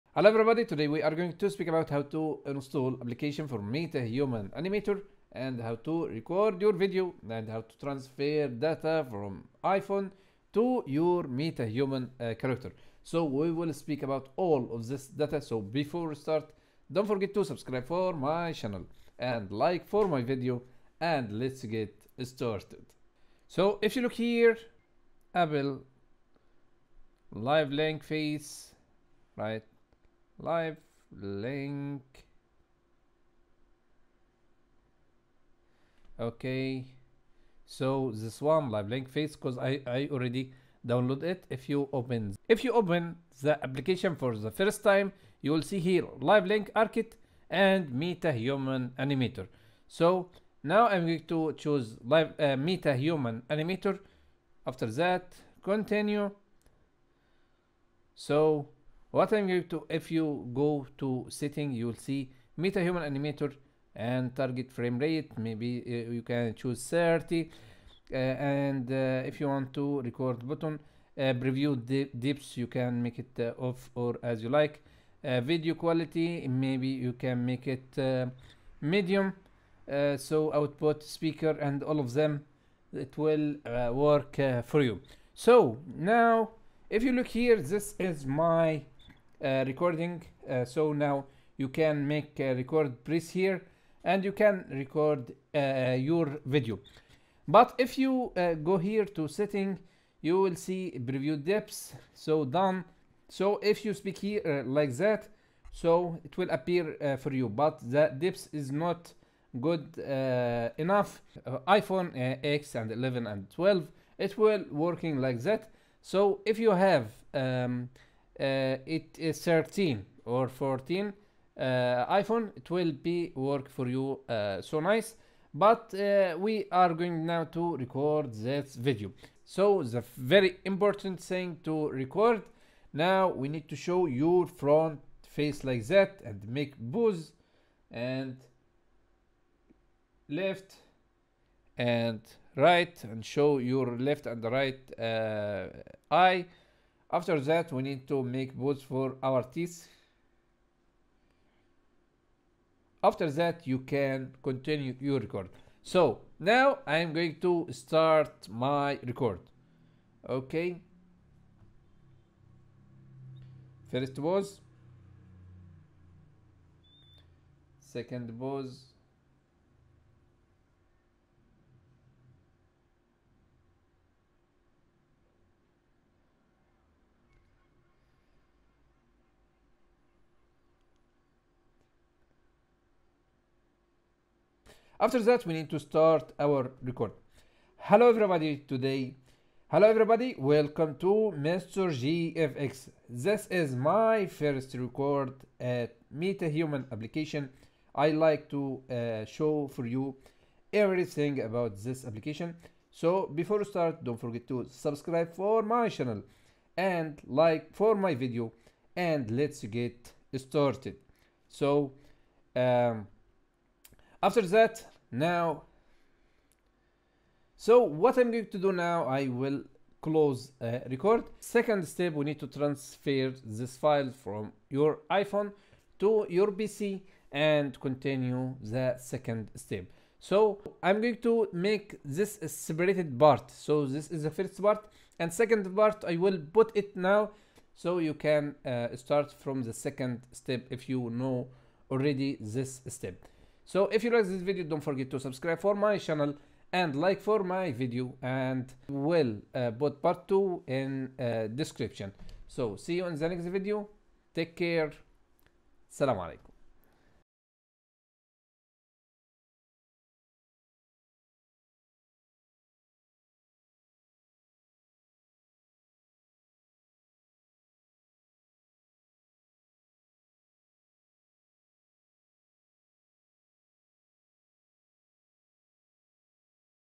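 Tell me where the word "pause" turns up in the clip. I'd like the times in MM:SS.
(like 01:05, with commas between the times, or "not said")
02:44, 02:48.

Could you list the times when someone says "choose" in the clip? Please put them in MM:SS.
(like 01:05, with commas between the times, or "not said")
00:51, 01:06.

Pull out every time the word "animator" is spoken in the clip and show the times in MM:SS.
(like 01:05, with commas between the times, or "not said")
00:04, 00:48, 00:53, 01:03.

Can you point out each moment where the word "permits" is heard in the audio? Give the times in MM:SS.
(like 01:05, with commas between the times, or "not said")
not said.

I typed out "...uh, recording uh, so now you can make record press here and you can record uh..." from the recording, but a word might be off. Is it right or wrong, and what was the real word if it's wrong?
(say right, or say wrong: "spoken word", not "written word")
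right.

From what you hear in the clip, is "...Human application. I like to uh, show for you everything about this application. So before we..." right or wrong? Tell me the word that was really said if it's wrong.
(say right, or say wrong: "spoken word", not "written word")
right.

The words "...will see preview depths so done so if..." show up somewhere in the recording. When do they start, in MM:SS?
01:40.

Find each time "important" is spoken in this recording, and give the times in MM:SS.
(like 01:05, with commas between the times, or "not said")
02:10.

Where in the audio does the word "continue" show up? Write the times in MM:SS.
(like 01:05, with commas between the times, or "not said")
00:55, 02:34, 03:47.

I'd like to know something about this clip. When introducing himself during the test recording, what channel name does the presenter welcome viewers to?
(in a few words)
Mr. GFX.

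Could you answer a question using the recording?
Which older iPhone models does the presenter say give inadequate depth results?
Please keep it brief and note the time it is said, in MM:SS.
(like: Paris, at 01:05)
iPhone X, 11 and 12, at 01:51.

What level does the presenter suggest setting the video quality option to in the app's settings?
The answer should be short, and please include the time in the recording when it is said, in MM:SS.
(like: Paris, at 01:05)
medium, at 01:18.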